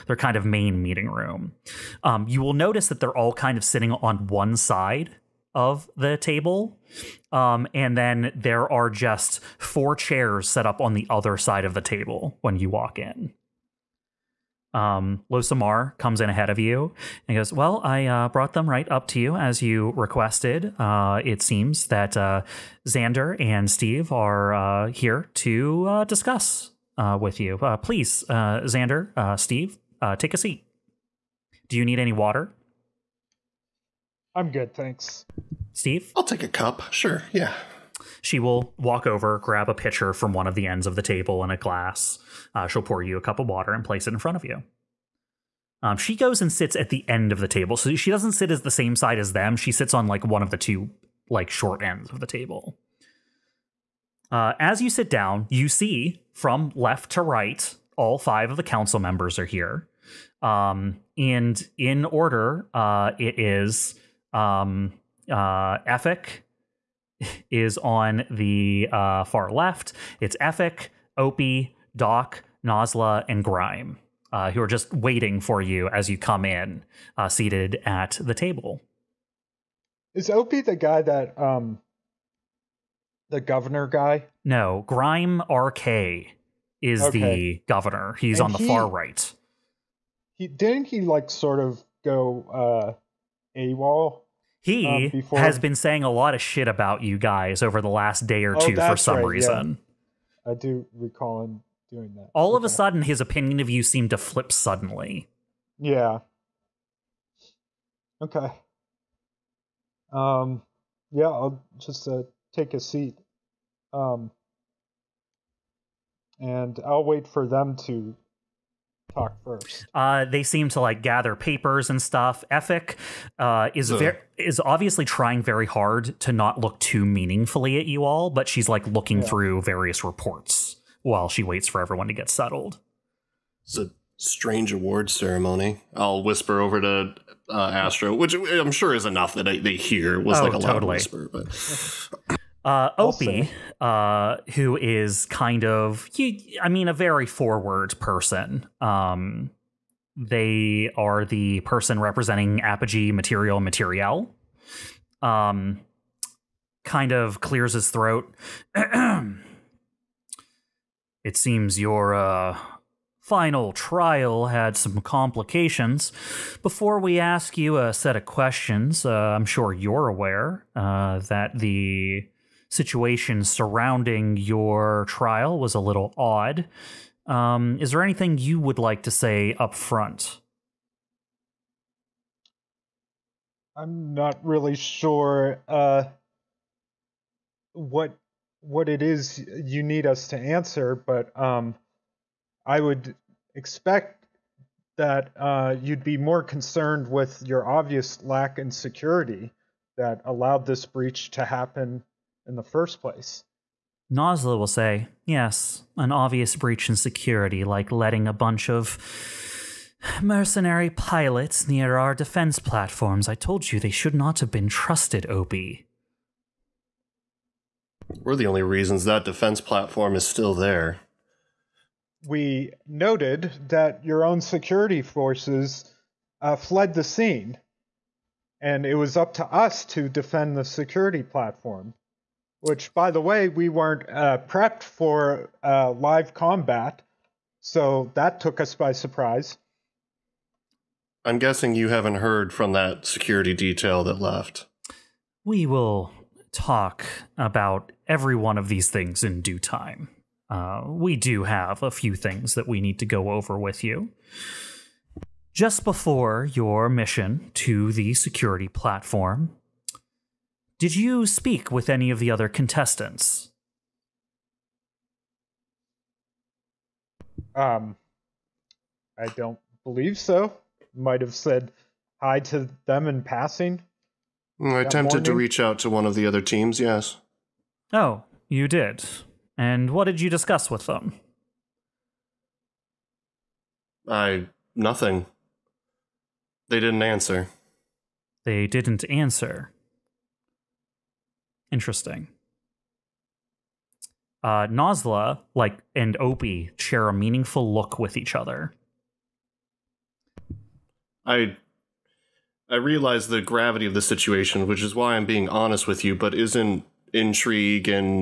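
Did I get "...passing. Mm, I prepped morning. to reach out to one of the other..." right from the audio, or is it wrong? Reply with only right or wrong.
wrong.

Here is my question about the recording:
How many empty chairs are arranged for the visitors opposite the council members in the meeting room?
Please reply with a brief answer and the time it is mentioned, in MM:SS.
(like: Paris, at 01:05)
4, at 00:09.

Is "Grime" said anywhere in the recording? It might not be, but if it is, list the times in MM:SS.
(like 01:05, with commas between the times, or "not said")
01:13, 01:24.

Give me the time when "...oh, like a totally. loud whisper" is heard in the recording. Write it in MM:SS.
02:20.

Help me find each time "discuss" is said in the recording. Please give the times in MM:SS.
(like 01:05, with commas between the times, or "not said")
00:26, 04:40.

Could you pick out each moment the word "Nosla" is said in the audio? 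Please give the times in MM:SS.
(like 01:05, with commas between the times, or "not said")
01:12, 03:24, 04:54.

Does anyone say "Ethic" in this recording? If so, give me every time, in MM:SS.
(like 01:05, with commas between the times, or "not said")
01:05, 01:10, 02:02.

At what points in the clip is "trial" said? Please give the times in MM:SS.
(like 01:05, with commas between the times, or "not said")
02:43, 02:55.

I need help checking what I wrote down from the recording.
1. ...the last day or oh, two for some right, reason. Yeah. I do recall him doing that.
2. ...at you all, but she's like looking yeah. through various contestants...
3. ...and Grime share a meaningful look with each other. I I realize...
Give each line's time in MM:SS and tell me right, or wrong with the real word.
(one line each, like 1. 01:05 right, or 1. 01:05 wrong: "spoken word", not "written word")
1. 01:37 right
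2. 02:07 wrong: "reports", not "contestants"
3. 04:55 wrong: "Opie", not "Grime".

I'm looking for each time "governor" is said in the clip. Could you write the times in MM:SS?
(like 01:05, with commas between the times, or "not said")
01:23, 01:27.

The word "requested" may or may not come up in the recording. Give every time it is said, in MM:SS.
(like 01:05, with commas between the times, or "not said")
00:19.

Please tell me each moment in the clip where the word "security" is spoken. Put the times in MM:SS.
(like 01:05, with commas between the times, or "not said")
03:18, 03:26, 03:44, 03:50, 04:03, 04:18.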